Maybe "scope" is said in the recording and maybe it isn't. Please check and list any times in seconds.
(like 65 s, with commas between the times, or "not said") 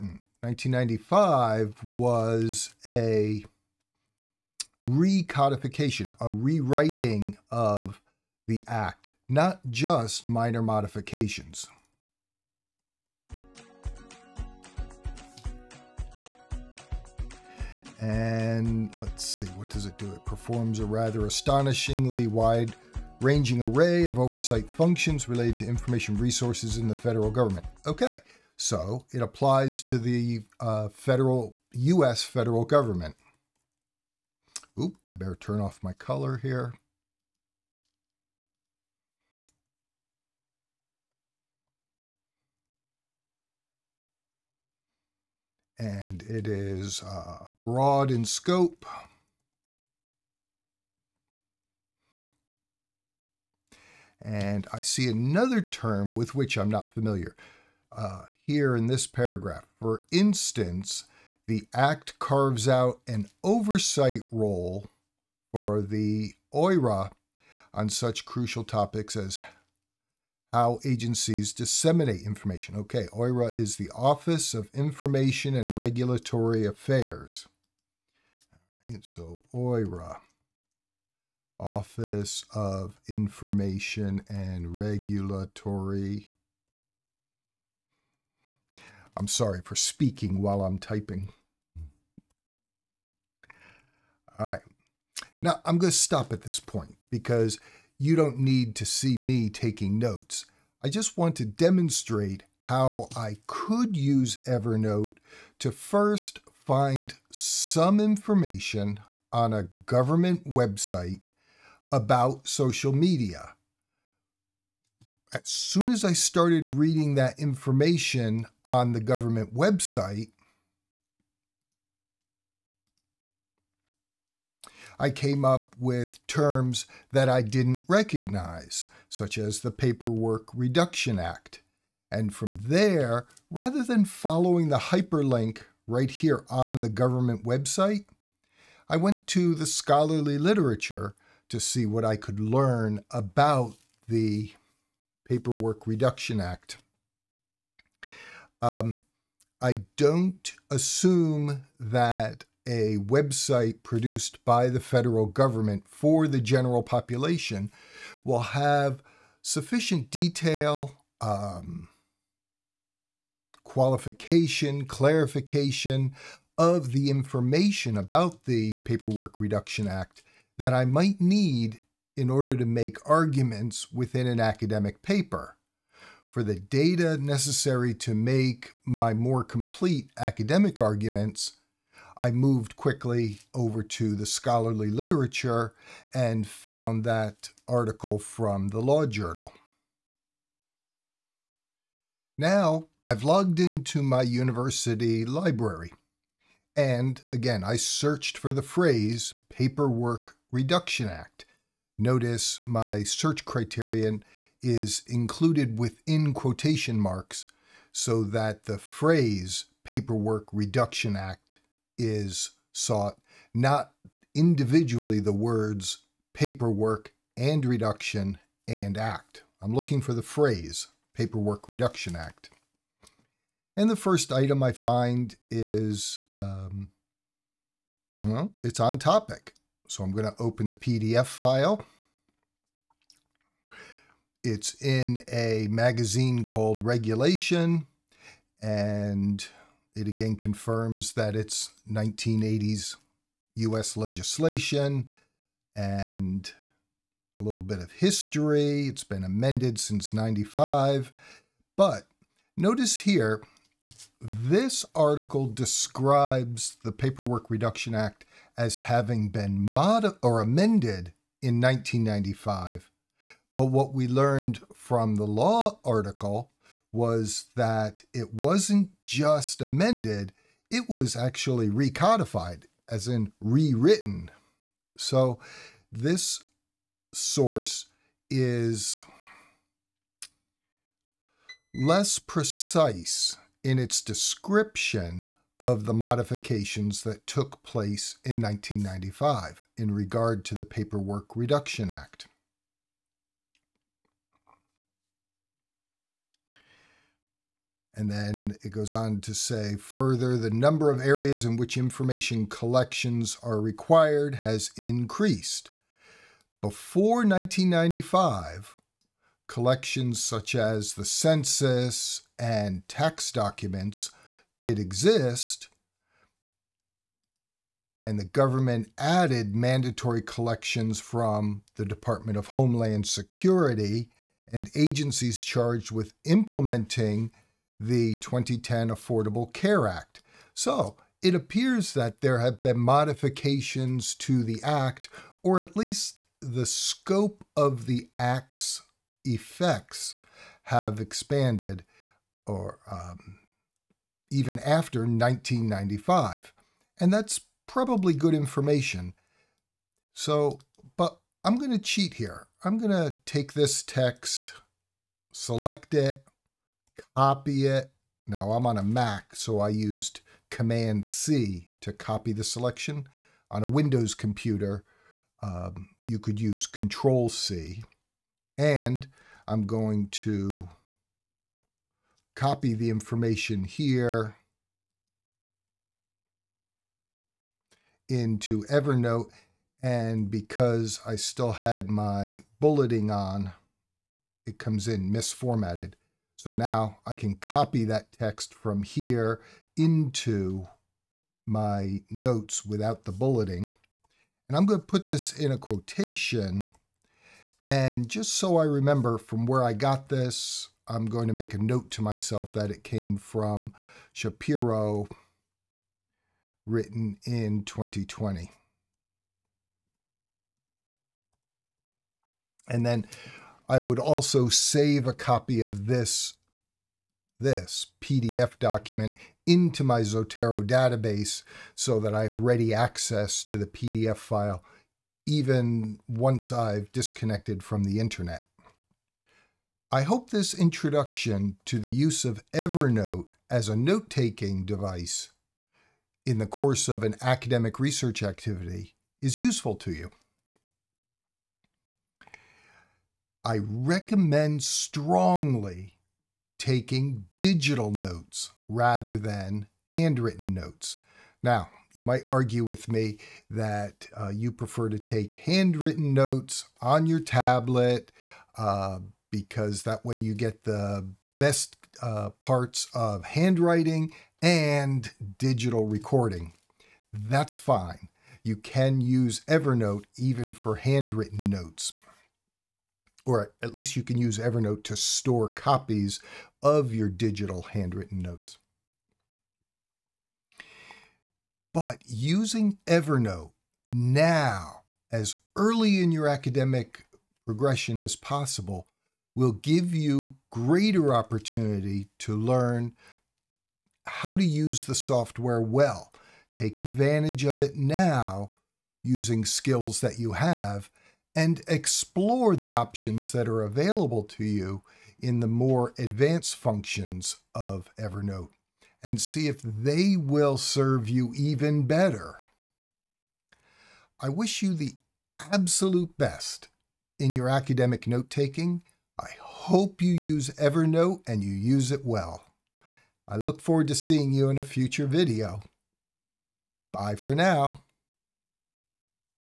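48 s, 336 s.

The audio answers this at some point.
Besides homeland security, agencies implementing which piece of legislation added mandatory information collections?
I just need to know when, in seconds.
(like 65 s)
328 s.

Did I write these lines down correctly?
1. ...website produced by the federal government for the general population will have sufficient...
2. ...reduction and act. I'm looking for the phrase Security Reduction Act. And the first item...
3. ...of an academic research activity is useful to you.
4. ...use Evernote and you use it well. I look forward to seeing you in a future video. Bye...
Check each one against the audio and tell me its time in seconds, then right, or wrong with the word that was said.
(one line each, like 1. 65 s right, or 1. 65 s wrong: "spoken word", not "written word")
1. 152 s right
2. 217 s wrong: "Paperwork", not "Security"
3. 436 s right
4. 520 s right.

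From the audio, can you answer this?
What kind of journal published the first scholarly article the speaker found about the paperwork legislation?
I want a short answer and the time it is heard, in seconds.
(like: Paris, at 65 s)
Law Journal, at 188 s.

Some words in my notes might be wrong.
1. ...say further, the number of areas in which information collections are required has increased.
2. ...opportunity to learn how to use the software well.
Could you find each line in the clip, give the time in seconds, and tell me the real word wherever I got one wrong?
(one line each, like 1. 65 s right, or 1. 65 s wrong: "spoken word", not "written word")
1. 299 s right
2. 491 s right.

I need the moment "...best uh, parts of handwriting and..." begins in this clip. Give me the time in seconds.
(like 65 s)
461 s.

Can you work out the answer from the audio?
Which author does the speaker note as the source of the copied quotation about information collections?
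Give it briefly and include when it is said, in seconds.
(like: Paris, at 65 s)
Shapiro, at 404 s.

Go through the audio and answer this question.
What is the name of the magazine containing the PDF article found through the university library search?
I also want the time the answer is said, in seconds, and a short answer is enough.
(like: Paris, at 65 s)
Regulation, at 236 s.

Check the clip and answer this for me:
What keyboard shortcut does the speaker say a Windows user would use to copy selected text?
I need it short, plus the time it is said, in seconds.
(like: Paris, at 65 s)
Control C, at 366 s.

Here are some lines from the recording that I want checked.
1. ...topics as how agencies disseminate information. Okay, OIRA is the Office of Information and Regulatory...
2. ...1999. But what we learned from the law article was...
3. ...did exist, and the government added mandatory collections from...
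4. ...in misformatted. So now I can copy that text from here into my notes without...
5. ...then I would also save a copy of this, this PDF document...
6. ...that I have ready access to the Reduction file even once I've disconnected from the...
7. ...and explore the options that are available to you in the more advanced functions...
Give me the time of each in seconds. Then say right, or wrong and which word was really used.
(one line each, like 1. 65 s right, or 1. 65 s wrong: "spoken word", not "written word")
1. 68 s right
2. 261 s wrong: "1995", not "1999"
3. 314 s right
4. 384 s right
5. 412 s right
6. 421 s wrong: "PDF", not "Reduction"
7. 501 s right.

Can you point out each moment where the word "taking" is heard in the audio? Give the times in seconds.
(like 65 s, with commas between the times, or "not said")
99 s, 433 s, 446 s, 518 s.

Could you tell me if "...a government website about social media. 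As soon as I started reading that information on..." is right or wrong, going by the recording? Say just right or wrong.
right.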